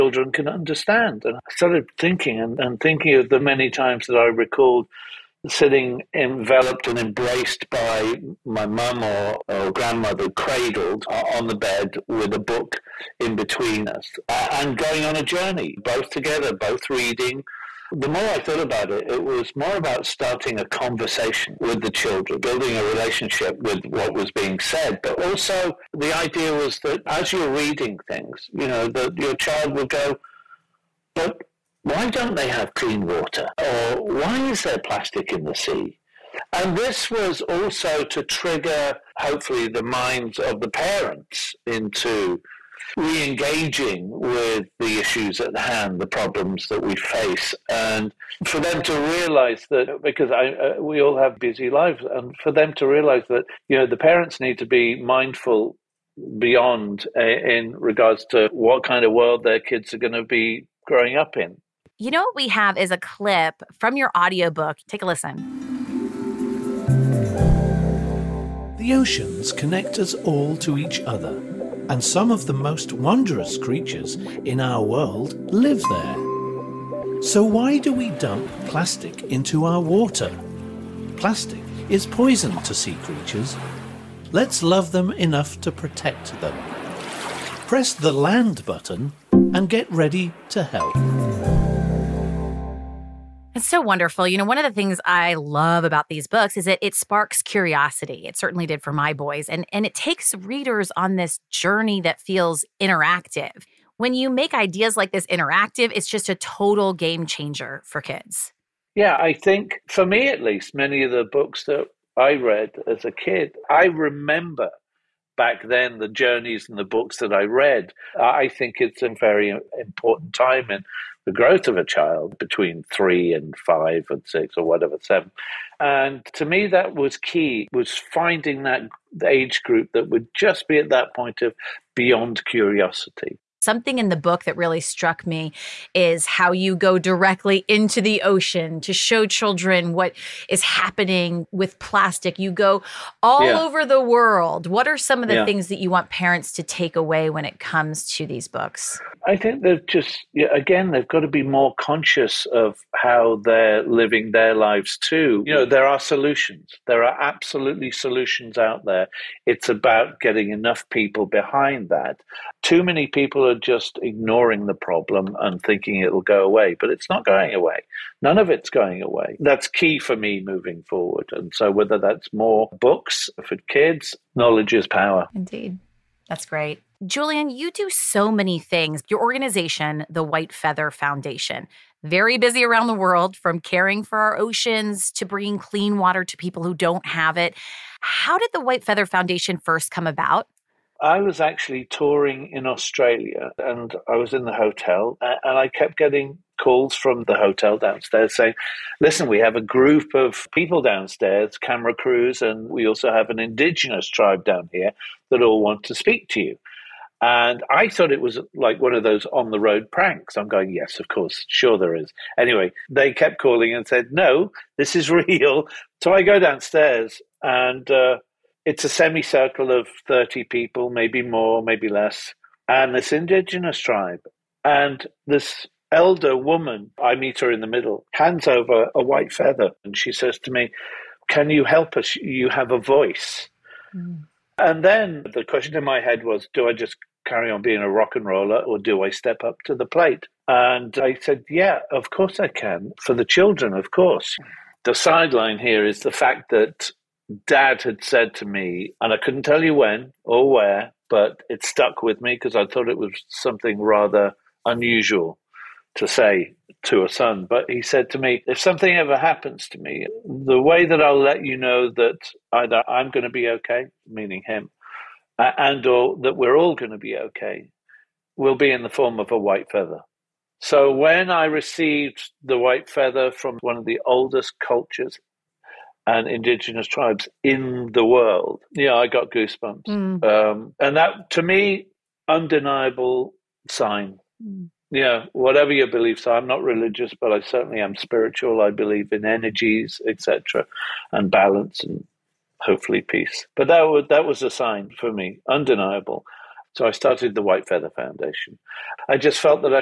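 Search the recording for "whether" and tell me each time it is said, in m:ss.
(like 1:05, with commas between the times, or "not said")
2:51.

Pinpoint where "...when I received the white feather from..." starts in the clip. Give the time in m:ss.
4:30.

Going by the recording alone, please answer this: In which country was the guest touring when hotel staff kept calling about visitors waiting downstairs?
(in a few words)
Australia.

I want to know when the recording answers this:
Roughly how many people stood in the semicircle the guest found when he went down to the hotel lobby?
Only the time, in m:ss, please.
3:40.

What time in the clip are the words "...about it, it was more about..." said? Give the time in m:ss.
0:18.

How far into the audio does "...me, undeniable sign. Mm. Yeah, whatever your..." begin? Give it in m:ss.
4:41.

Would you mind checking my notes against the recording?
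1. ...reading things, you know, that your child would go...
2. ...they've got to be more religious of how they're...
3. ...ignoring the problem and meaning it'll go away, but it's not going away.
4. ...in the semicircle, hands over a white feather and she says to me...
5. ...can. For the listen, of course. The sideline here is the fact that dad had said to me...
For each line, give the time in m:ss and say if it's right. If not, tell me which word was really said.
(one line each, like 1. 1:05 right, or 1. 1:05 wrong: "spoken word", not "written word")
1. 0:27 right
2. 2:30 wrong: "conscious", not "religious"
3. 2:44 wrong: "thinking", not "meaning"
4. 3:47 wrong: "middle", not "semicircle"
5. 4:02 wrong: "children", not "listen".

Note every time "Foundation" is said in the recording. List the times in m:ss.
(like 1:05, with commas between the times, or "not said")
3:00, 3:09, 4:57.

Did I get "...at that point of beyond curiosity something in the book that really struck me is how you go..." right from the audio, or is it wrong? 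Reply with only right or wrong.
right.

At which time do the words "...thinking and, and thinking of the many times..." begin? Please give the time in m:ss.
0:01.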